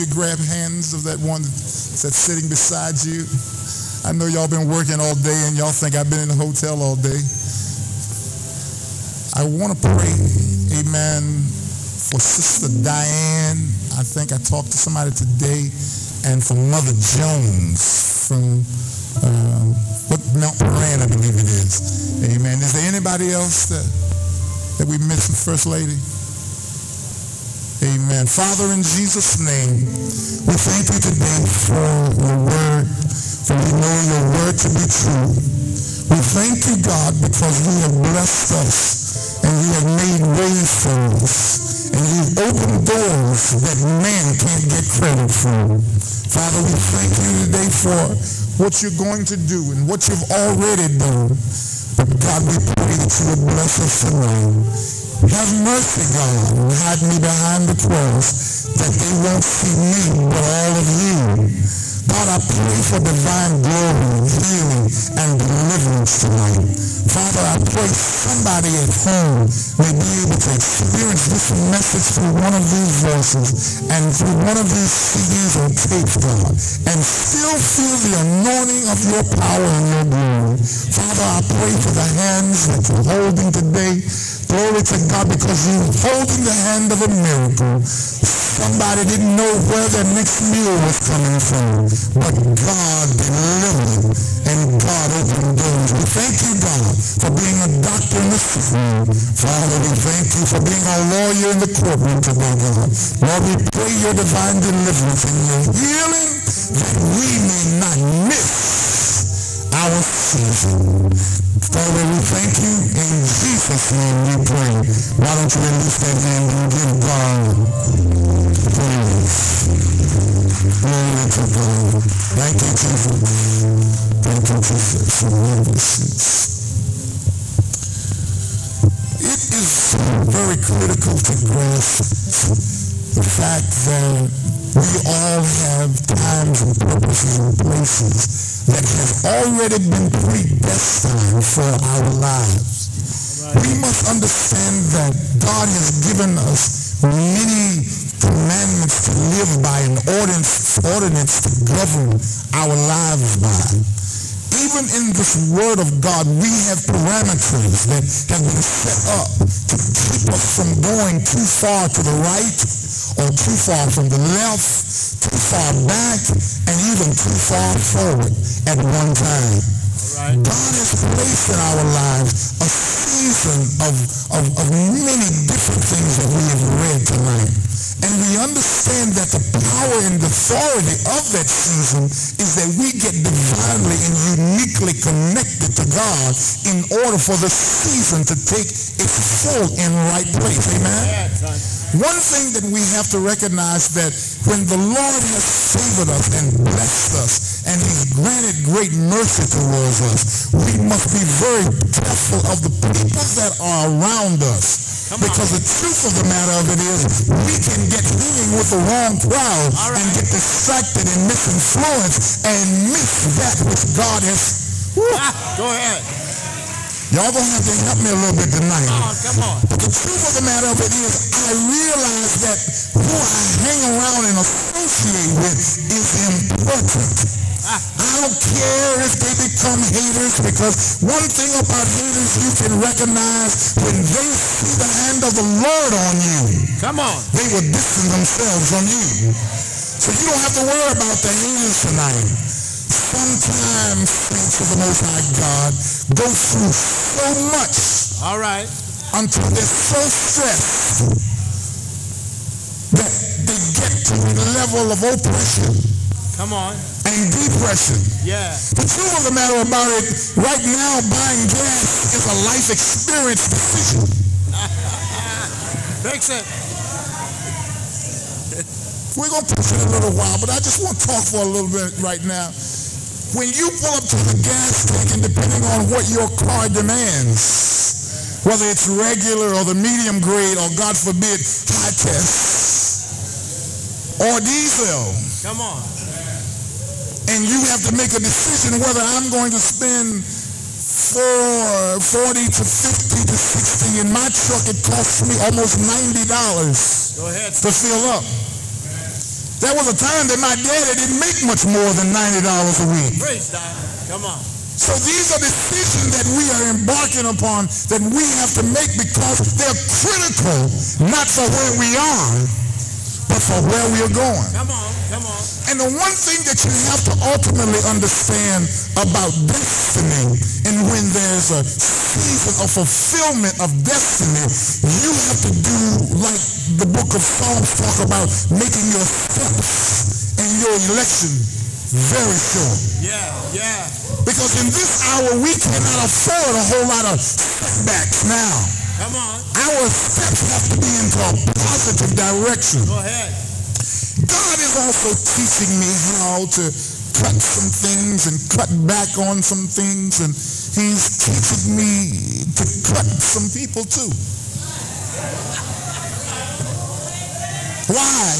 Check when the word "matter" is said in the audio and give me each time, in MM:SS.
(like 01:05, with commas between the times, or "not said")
03:26, 03:40, 04:19.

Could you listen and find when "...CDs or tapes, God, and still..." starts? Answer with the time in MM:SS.
01:14.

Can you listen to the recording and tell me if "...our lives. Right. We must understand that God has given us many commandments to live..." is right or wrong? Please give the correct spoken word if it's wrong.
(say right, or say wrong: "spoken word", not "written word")
right.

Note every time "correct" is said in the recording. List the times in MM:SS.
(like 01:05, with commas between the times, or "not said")
not said.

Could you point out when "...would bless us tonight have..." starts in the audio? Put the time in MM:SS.
00:53.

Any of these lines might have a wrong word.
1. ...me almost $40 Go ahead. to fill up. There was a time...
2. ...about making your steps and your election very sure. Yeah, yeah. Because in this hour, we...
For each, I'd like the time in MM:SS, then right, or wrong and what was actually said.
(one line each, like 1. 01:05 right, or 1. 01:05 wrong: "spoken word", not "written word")
1. 04:55 wrong: "90", not "40"
2. 05:28 right.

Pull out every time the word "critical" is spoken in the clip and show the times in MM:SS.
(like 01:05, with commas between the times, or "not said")
02:10, 05:09.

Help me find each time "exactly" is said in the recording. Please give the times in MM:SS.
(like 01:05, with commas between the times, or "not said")
not said.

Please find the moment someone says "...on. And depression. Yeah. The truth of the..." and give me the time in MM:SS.
04:16.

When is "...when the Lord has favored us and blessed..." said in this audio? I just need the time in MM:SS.
03:14.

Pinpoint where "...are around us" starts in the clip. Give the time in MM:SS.
03:23.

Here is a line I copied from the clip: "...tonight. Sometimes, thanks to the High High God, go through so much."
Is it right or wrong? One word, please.
wrong.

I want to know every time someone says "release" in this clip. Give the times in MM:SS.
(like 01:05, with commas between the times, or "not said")
01:55.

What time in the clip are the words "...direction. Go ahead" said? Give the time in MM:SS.
05:42.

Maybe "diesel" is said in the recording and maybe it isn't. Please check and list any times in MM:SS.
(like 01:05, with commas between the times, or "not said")
04:44.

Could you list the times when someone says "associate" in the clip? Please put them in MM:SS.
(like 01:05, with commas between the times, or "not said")
03:44.